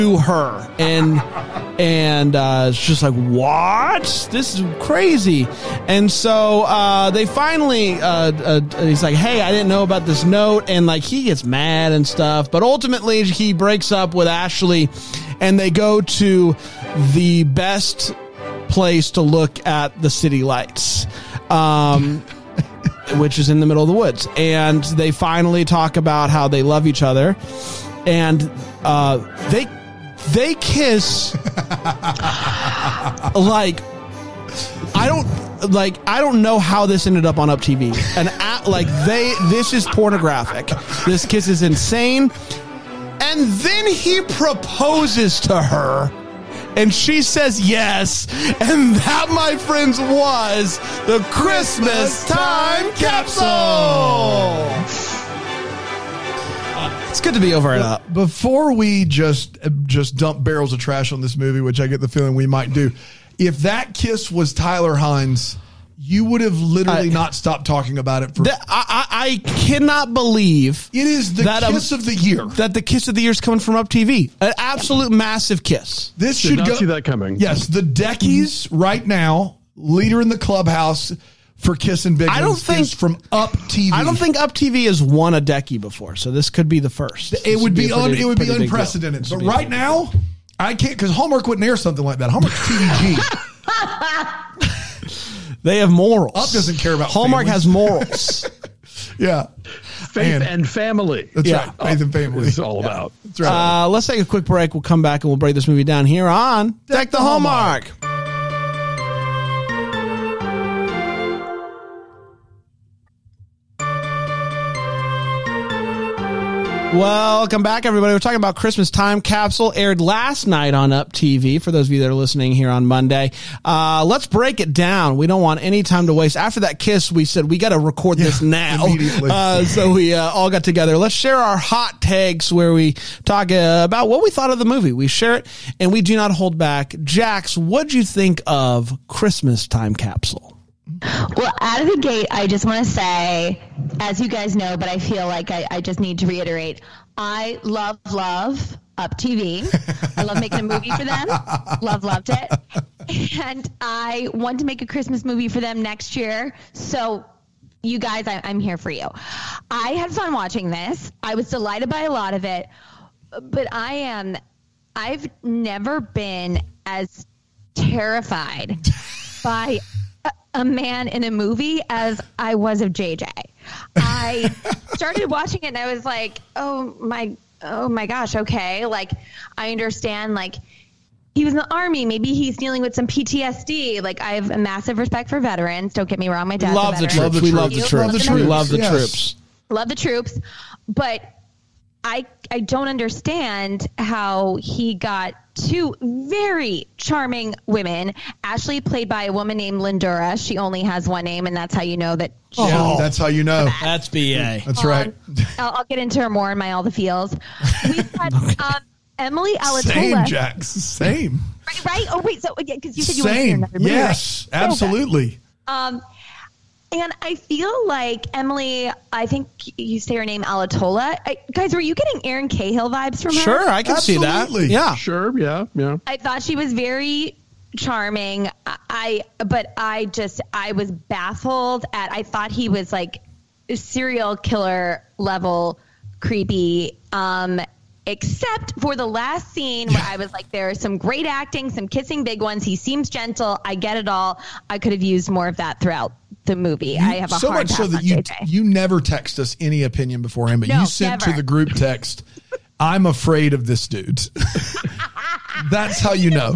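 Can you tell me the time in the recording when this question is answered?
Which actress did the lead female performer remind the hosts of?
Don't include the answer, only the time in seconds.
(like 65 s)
222 s.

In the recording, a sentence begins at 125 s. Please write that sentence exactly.
We don't want any time to waste.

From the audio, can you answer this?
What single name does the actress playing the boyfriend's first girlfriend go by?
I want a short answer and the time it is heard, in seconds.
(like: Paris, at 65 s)
Lindura, at 199 s.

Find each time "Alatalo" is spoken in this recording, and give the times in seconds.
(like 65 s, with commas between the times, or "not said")
209 s, 220 s.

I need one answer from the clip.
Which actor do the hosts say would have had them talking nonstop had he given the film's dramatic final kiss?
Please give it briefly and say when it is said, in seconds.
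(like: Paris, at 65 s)
Tyler Hynes, at 64 s.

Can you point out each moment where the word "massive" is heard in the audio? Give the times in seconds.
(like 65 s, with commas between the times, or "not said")
75 s, 184 s.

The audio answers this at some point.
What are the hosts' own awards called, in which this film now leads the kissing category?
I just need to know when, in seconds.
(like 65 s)
77 s.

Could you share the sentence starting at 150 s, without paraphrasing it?
I love making a movie for them.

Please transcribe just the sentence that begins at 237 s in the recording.
Um, except for the last scene where I was like, there's some great acting, some kissing big ones.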